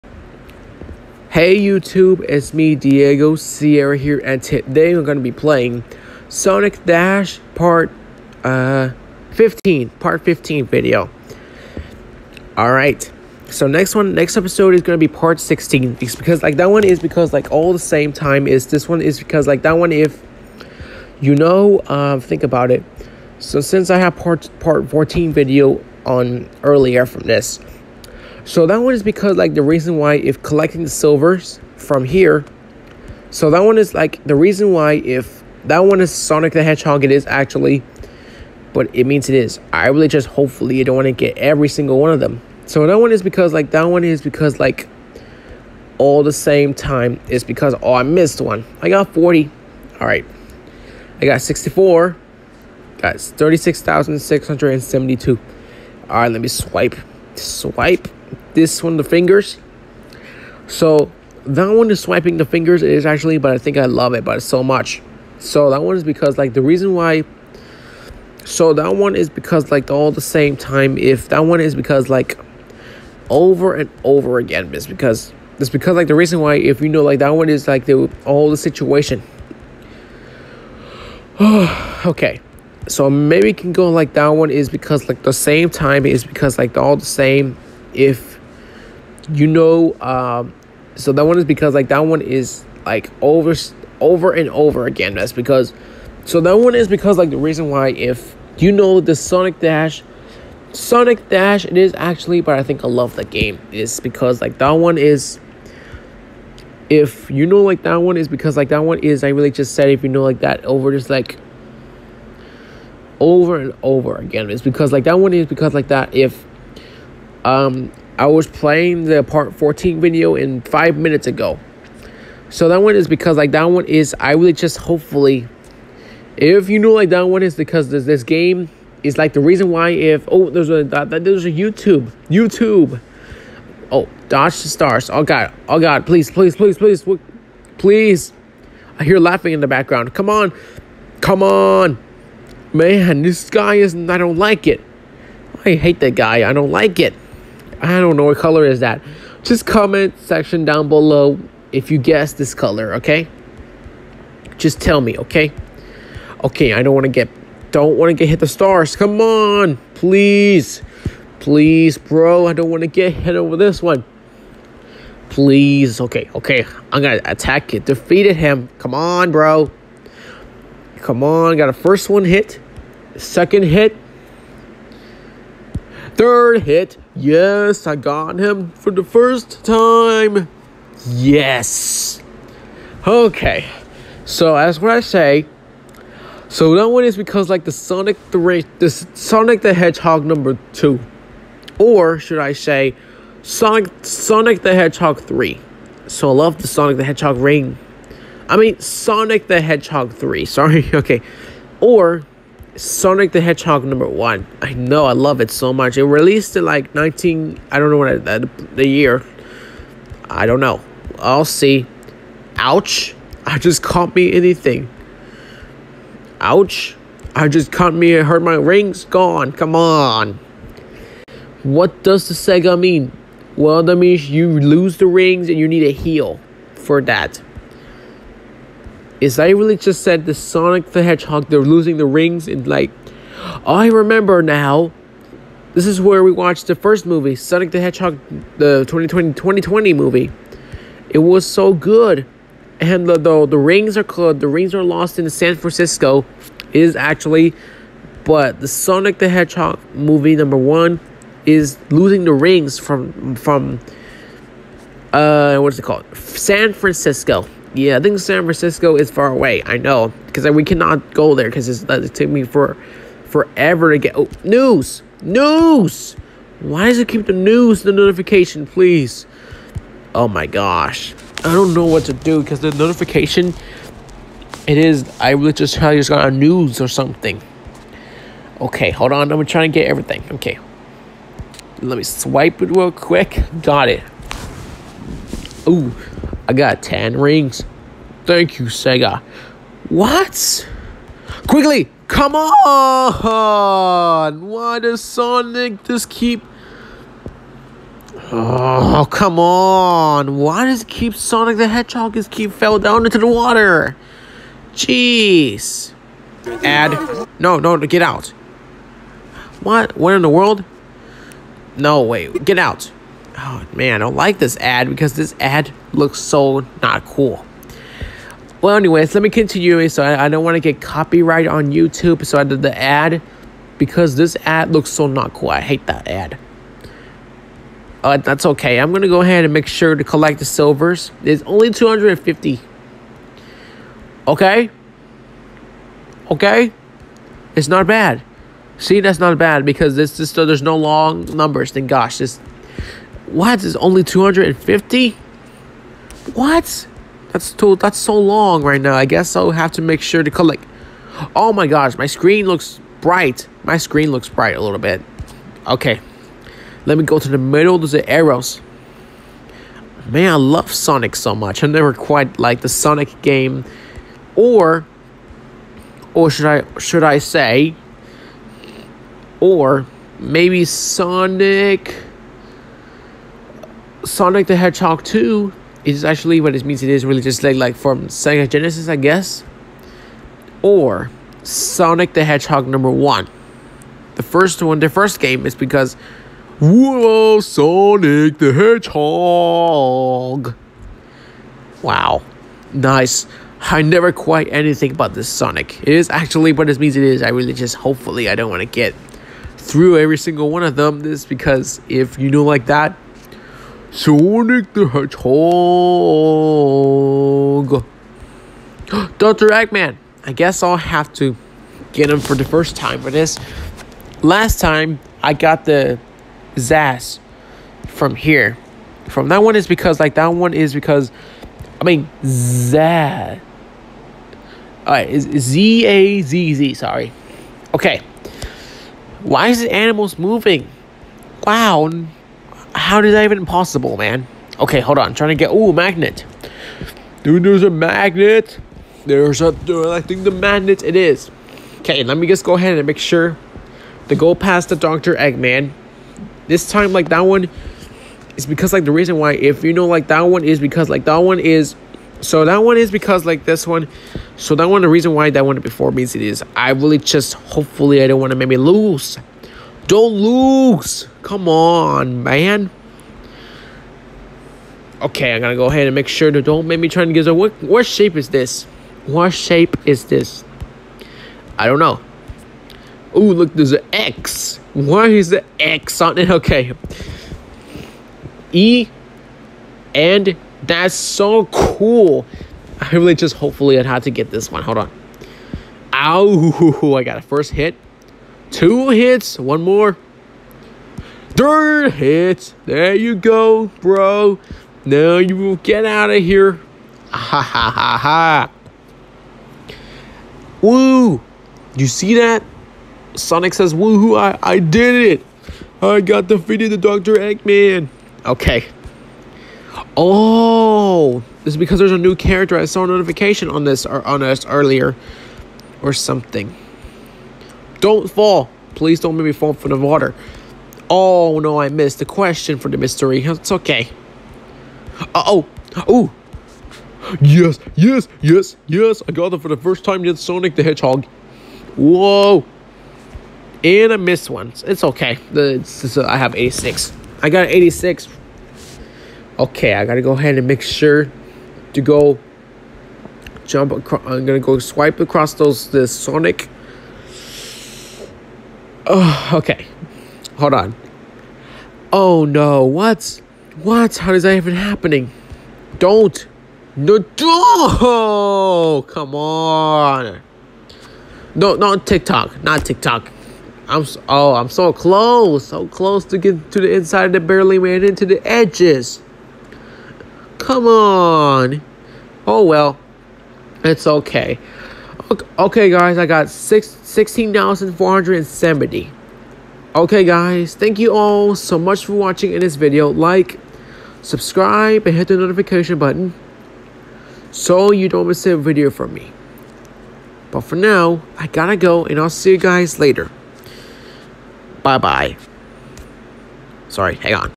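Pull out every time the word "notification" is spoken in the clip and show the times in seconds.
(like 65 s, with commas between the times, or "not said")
267 s, 272 s, 512 s, 585 s.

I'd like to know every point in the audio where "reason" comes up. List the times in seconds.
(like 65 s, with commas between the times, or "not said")
29 s, 34 s, 66 s, 76 s, 97 s, 129 s, 448 s, 454 s.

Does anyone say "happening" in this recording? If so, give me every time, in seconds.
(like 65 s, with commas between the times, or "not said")
554 s.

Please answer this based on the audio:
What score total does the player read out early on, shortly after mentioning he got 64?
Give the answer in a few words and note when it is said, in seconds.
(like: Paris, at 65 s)
36,672, at 53 s.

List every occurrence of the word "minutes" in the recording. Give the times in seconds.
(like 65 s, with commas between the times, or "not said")
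120 s.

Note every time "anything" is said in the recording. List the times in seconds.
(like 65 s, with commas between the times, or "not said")
214 s, 394 s.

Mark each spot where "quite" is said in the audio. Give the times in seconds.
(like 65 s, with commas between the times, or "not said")
361 s, 394 s.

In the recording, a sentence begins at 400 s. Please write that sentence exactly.
This because if you know like that, Sonic the Hedgehog.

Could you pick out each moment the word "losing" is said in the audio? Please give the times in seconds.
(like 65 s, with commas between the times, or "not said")
231 s, 251 s.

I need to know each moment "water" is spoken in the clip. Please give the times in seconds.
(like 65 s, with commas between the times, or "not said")
303 s, 519 s.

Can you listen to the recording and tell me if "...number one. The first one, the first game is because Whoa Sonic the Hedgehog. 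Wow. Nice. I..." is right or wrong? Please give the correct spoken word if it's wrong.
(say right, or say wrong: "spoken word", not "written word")
right.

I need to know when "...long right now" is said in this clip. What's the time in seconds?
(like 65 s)
348 s.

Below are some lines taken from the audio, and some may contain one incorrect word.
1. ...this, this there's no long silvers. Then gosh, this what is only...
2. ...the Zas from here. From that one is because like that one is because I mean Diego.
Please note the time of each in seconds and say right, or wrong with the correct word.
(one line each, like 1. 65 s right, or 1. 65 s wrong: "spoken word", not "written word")
1. 339 s wrong: "numbers", not "silvers"
2. 415 s wrong: "Zazz", not "Diego".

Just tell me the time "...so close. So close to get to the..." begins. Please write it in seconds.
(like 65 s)
564 s.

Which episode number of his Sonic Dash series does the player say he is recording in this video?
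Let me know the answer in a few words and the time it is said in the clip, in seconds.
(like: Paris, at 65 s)
15, at 9 s.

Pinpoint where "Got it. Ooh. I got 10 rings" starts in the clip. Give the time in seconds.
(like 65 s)
283 s.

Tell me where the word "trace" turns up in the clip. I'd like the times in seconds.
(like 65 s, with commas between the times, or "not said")
not said.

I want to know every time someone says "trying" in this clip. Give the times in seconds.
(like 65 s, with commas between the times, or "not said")
279 s, 435 s.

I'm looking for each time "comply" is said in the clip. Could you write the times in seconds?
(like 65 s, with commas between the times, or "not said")
not said.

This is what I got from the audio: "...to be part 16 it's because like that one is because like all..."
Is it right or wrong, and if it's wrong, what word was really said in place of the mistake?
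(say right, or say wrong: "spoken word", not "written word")
right.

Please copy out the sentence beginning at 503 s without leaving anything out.
Sonic says, woohoo, I, I did it.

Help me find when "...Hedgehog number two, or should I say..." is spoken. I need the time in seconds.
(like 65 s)
189 s.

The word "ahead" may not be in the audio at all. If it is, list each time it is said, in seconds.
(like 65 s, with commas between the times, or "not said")
329 s, 442 s, 465 s, 540 s.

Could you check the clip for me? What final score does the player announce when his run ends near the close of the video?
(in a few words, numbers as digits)
16,470.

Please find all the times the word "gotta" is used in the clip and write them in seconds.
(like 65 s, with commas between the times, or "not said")
539 s, 591 s.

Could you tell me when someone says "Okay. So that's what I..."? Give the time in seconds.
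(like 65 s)
183 s.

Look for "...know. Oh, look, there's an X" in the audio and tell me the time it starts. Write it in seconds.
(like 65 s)
471 s.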